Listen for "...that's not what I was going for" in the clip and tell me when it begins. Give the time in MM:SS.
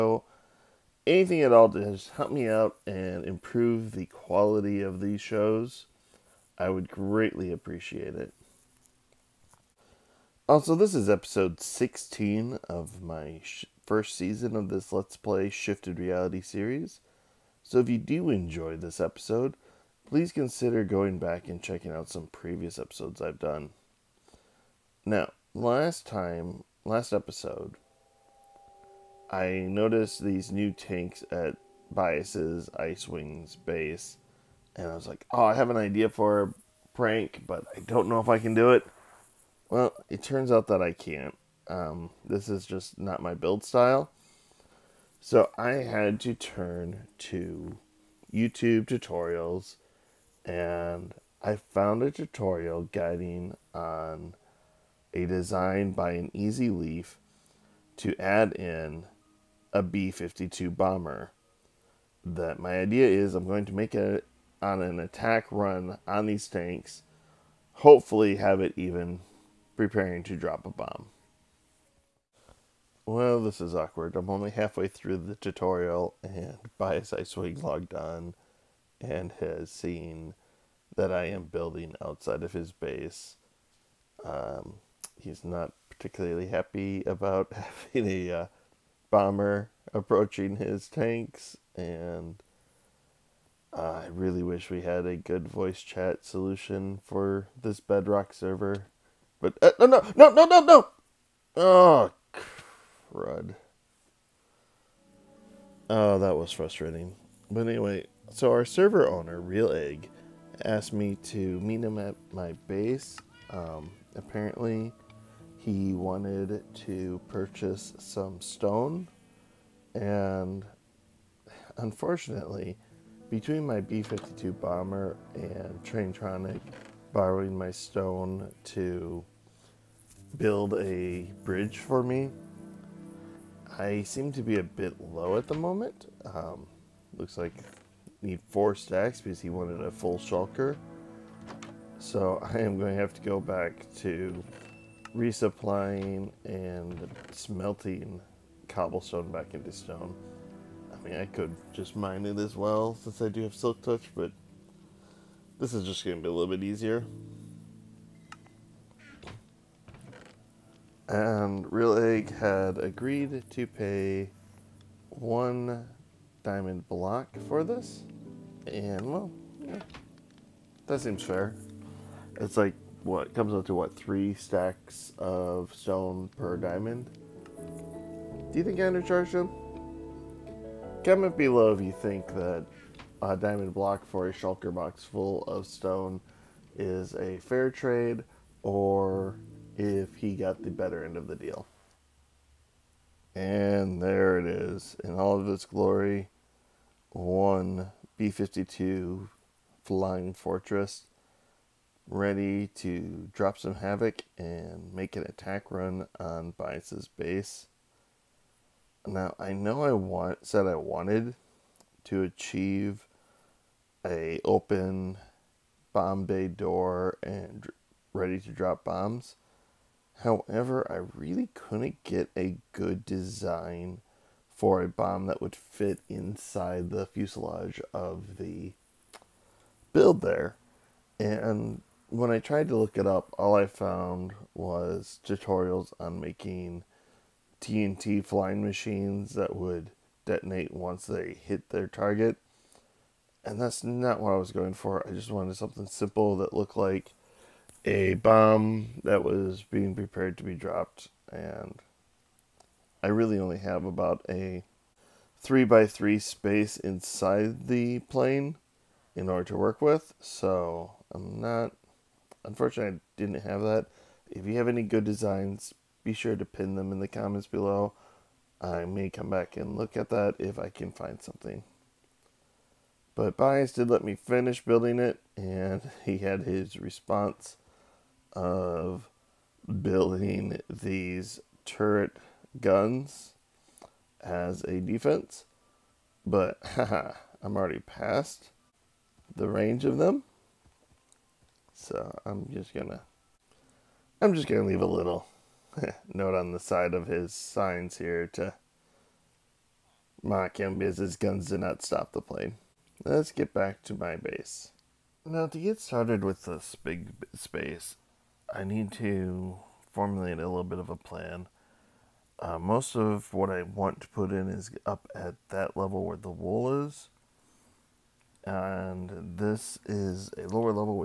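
04:03.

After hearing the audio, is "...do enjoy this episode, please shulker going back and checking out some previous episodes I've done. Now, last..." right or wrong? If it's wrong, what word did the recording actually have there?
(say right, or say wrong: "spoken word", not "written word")
wrong: "consider", not "shulker".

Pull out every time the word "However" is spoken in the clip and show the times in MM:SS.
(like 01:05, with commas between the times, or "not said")
03:40.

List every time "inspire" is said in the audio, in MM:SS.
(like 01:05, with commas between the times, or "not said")
not said.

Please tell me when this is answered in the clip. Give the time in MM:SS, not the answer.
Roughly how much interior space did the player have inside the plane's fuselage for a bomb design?
04:15.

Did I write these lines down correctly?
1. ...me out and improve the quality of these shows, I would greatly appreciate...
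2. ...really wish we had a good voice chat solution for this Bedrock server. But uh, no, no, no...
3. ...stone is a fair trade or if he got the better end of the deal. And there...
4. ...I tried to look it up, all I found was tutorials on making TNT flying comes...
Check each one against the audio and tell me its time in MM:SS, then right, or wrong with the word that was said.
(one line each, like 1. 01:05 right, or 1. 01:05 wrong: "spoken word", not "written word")
1. 00:02 right
2. 01:34 right
3. 03:05 right
4. 03:52 wrong: "machines", not "comes".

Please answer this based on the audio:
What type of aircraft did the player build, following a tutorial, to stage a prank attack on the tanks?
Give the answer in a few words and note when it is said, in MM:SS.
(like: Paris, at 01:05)
B-52 bomber, at 00:59.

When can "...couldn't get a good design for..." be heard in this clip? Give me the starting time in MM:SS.
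03:41.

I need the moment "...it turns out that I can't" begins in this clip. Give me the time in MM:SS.
00:40.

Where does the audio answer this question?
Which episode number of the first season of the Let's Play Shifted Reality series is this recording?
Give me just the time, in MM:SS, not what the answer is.
00:11.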